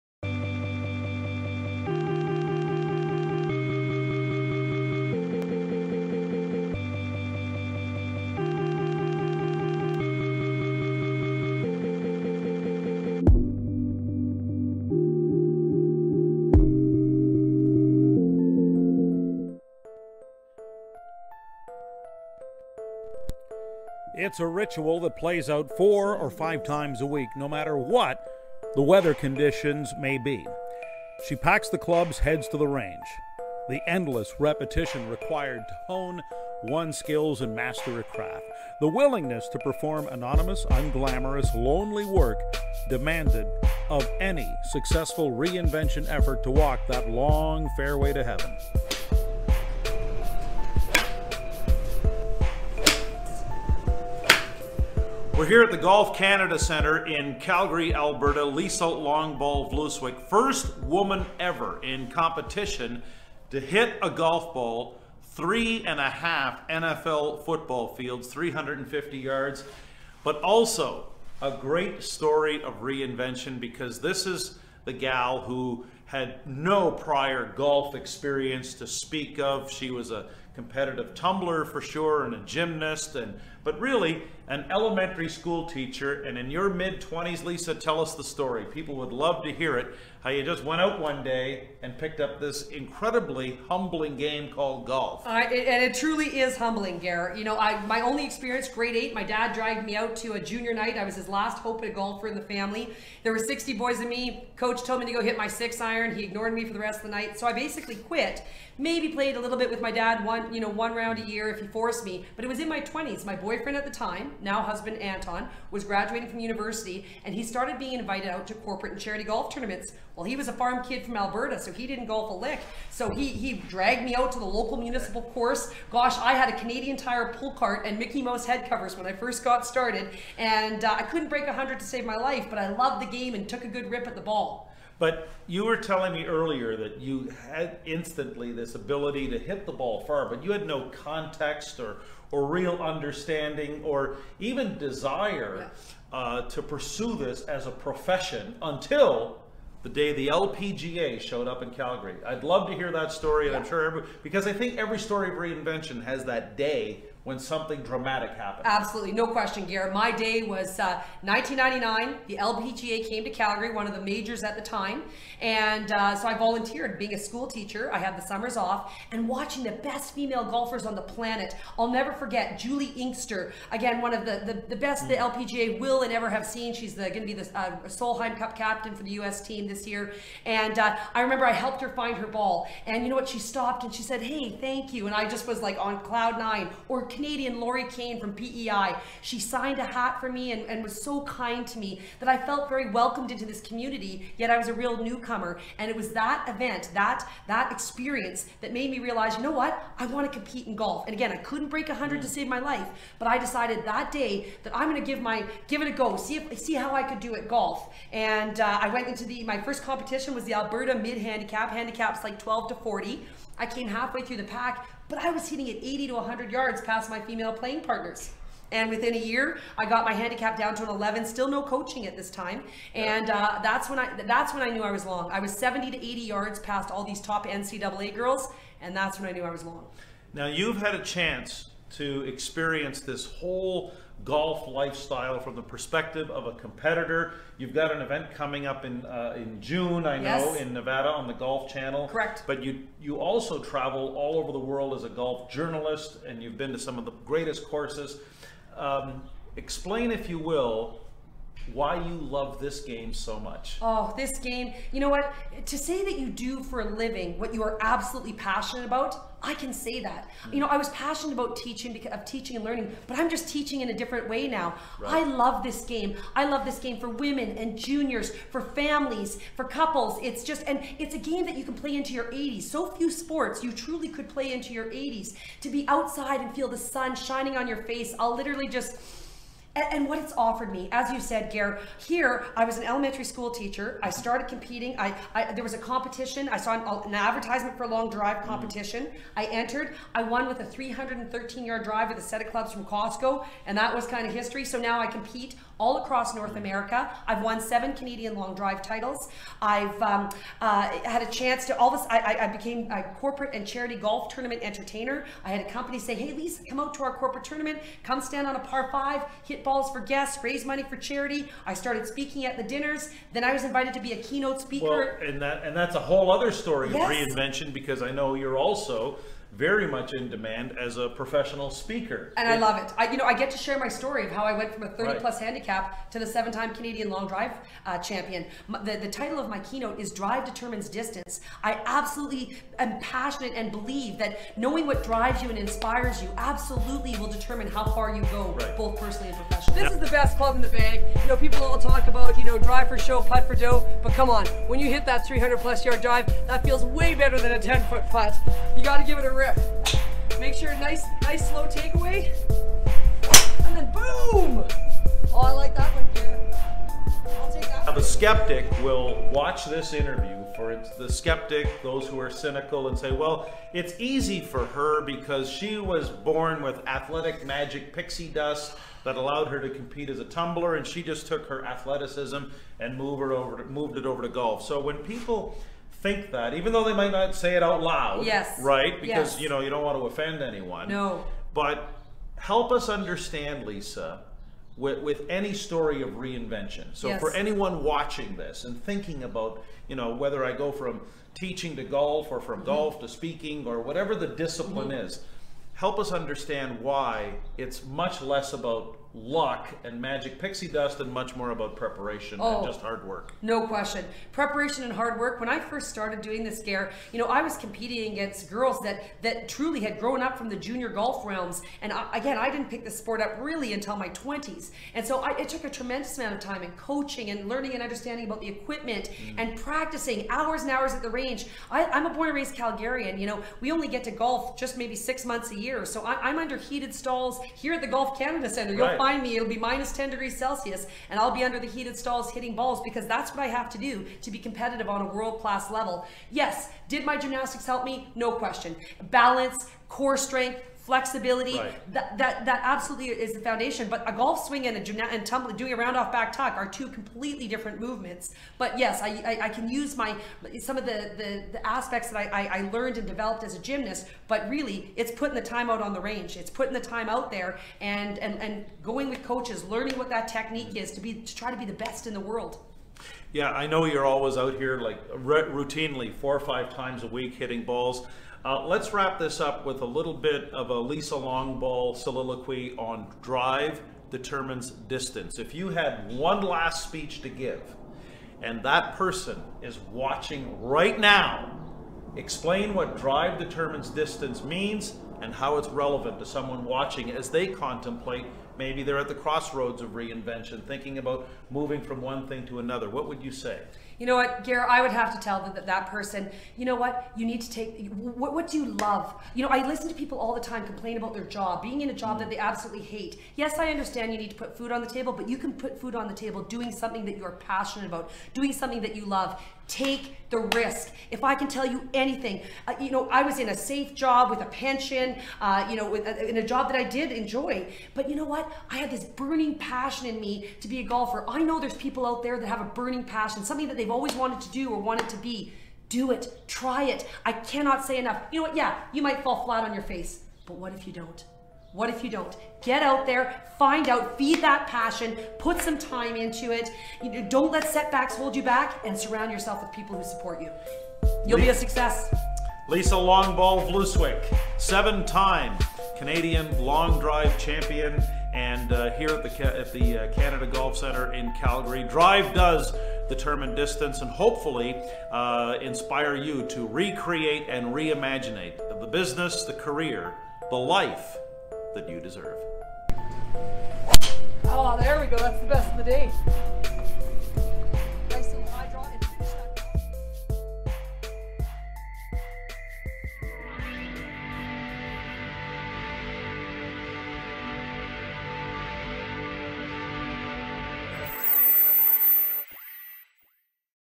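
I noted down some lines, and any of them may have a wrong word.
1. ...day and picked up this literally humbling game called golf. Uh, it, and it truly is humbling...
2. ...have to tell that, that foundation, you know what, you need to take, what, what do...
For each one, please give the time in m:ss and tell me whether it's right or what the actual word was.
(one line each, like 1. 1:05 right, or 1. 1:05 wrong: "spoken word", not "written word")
1. 1:31 wrong: "incredibly", not "literally"
2. 8:14 wrong: "person", not "foundation".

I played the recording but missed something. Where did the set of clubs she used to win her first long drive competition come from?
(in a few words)
Costco.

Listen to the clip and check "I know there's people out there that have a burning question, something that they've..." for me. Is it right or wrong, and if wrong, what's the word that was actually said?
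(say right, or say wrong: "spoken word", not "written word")
wrong: "passion", not "question".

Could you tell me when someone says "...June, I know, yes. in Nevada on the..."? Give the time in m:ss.
3:59.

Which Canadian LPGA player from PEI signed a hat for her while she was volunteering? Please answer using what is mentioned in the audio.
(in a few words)
Lori Kane.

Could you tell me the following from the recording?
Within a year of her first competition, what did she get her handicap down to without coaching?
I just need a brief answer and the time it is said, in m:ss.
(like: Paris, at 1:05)
11, at 3:40.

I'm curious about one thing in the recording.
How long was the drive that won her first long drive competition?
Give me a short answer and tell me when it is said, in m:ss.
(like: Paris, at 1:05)
313 yards, at 4:50.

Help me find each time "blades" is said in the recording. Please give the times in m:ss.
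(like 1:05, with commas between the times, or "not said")
not said.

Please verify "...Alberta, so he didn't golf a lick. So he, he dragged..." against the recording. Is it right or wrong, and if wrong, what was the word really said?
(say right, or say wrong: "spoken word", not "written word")
right.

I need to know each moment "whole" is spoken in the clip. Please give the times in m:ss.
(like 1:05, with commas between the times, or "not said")
3:53, 5:15.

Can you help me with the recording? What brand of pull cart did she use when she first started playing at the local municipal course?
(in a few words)
Canadian Tire.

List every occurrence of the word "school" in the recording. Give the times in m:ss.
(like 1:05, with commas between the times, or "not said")
1:25, 2:47, 4:43.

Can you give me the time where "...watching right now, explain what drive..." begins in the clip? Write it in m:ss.
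7:59.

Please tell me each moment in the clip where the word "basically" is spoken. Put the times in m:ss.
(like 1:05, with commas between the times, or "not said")
1:47.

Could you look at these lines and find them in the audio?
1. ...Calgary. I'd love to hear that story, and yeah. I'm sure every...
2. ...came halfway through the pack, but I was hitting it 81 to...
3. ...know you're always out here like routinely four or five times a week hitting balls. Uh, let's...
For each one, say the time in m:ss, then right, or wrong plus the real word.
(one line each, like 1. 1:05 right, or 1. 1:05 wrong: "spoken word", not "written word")
1. 2:31 right
2. 3:33 wrong: "80", not "81"
3. 7:43 right.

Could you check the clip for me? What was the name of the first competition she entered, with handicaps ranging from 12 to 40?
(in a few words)
Alberta mid handicap.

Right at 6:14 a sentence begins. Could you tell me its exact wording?
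So when people think that, even though they might not say it out loud.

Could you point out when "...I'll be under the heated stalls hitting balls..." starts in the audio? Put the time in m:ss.
7:11.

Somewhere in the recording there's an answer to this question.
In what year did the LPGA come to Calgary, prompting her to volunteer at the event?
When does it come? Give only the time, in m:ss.
2:41.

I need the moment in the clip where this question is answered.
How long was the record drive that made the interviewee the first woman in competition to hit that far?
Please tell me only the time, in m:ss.
1:08.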